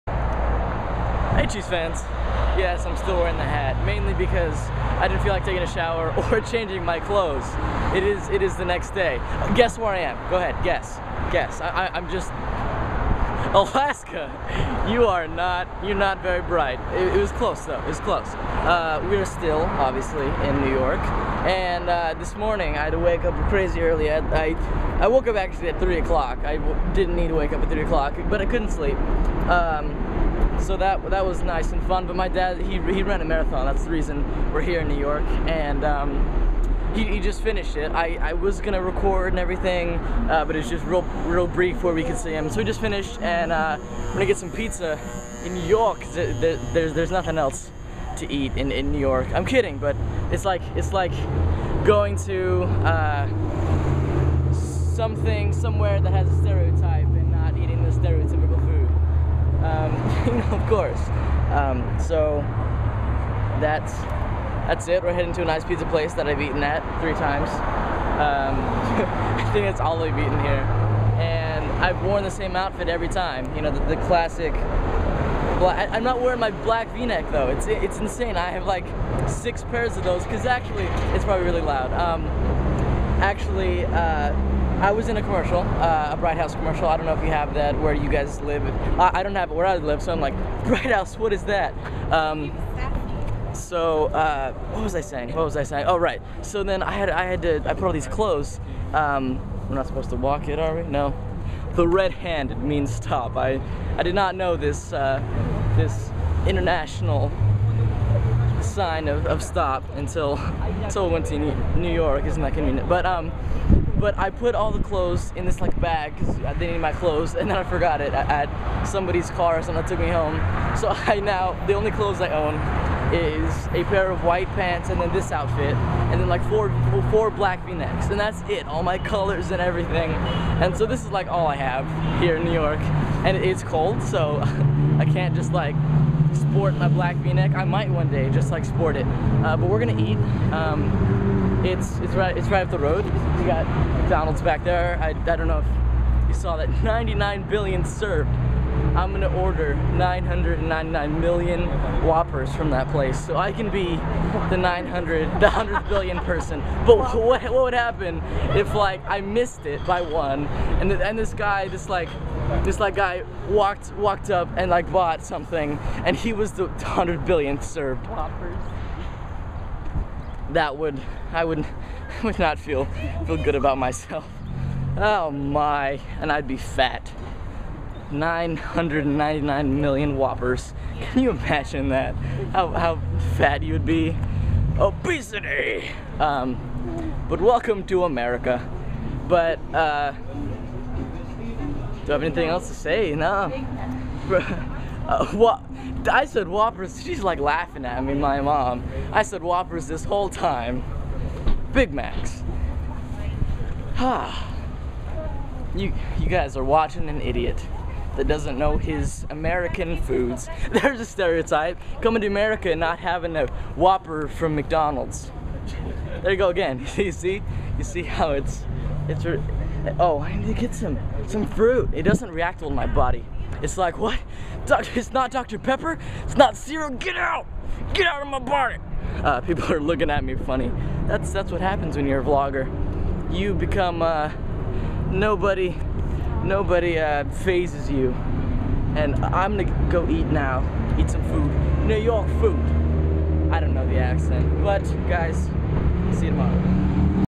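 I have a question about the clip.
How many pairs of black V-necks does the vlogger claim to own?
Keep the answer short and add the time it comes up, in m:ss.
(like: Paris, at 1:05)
6, at 1:19.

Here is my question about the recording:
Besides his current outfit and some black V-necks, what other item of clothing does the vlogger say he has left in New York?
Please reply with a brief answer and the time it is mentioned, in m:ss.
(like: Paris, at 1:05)
white pants, at 2:04.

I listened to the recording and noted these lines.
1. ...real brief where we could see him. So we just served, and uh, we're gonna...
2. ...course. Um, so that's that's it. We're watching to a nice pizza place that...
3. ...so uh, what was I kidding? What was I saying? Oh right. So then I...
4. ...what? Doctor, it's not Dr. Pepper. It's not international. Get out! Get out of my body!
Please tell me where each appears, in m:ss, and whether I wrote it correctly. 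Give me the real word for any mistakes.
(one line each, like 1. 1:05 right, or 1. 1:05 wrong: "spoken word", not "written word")
1. 0:41 wrong: "finished", not "served"
2. 1:00 wrong: "heading", not "watching"
3. 1:33 wrong: "saying", not "kidding"
4. 3:43 wrong: "cereal", not "international".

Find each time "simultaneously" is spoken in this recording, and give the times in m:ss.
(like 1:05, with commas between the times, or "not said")
not said.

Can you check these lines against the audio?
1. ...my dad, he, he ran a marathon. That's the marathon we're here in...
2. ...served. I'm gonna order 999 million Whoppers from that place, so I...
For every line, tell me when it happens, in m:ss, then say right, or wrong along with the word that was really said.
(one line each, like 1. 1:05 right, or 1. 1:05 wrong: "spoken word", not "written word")
1. 0:32 wrong: "reason", not "marathon"
2. 2:27 right.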